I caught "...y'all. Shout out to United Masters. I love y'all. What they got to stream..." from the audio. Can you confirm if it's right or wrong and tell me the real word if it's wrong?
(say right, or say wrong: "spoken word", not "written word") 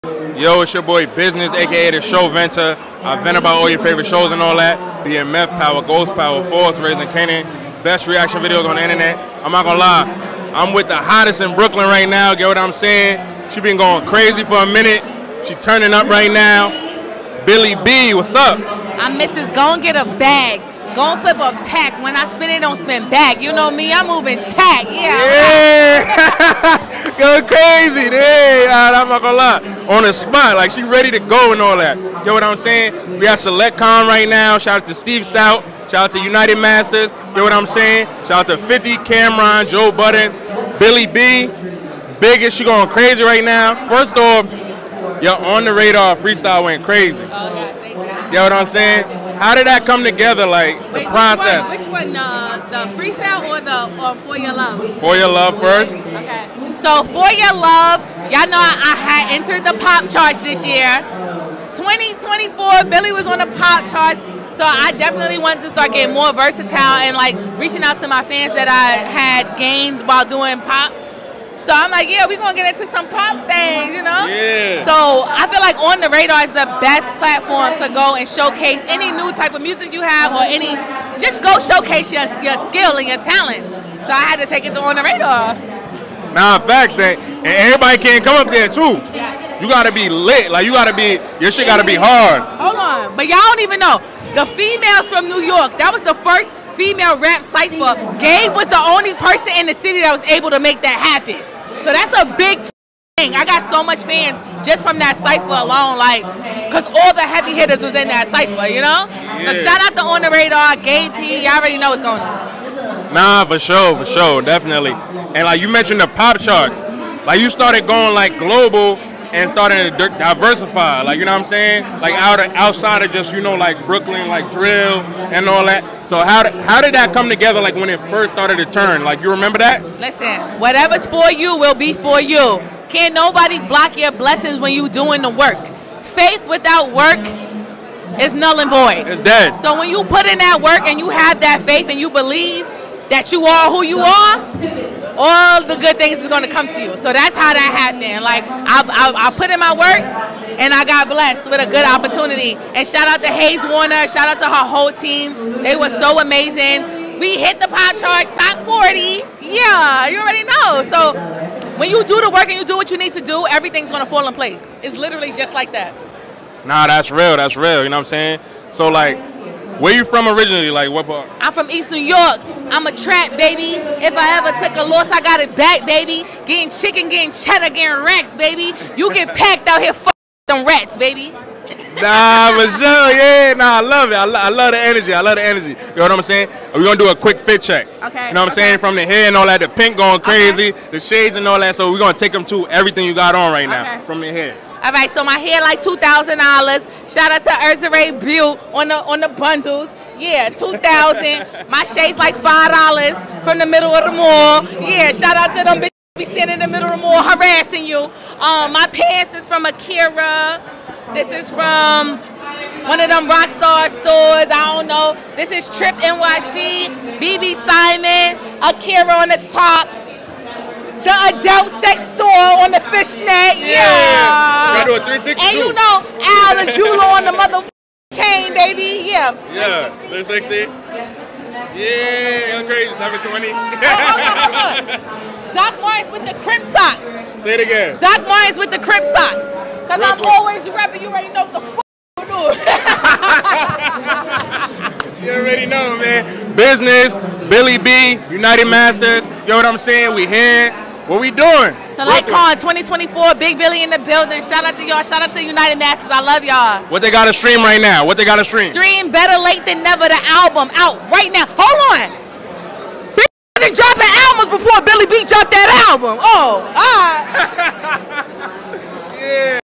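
right.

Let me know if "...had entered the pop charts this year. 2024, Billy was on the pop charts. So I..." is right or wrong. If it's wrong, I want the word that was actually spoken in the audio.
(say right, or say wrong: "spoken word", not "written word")
right.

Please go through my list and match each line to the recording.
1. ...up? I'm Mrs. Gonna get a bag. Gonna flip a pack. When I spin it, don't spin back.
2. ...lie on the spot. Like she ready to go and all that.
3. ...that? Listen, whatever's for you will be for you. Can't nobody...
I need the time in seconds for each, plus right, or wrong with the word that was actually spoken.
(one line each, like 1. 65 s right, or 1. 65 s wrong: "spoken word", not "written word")
1. 18 s right
2. 29 s right
3. 129 s right.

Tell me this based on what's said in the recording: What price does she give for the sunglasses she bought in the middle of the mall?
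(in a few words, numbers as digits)
$5.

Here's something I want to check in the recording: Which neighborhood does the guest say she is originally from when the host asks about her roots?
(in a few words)
East New York.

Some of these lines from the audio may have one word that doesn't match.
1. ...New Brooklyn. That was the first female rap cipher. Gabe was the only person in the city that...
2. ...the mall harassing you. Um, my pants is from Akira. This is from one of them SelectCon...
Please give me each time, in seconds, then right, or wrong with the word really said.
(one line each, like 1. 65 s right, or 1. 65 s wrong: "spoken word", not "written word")
1. 95 s wrong: "York", not "Brooklyn"
2. 206 s wrong: "Rockstar", not "SelectCon".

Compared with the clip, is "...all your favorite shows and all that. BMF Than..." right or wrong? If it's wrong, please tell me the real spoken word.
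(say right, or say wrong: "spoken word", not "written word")
wrong: "Power", not "Than".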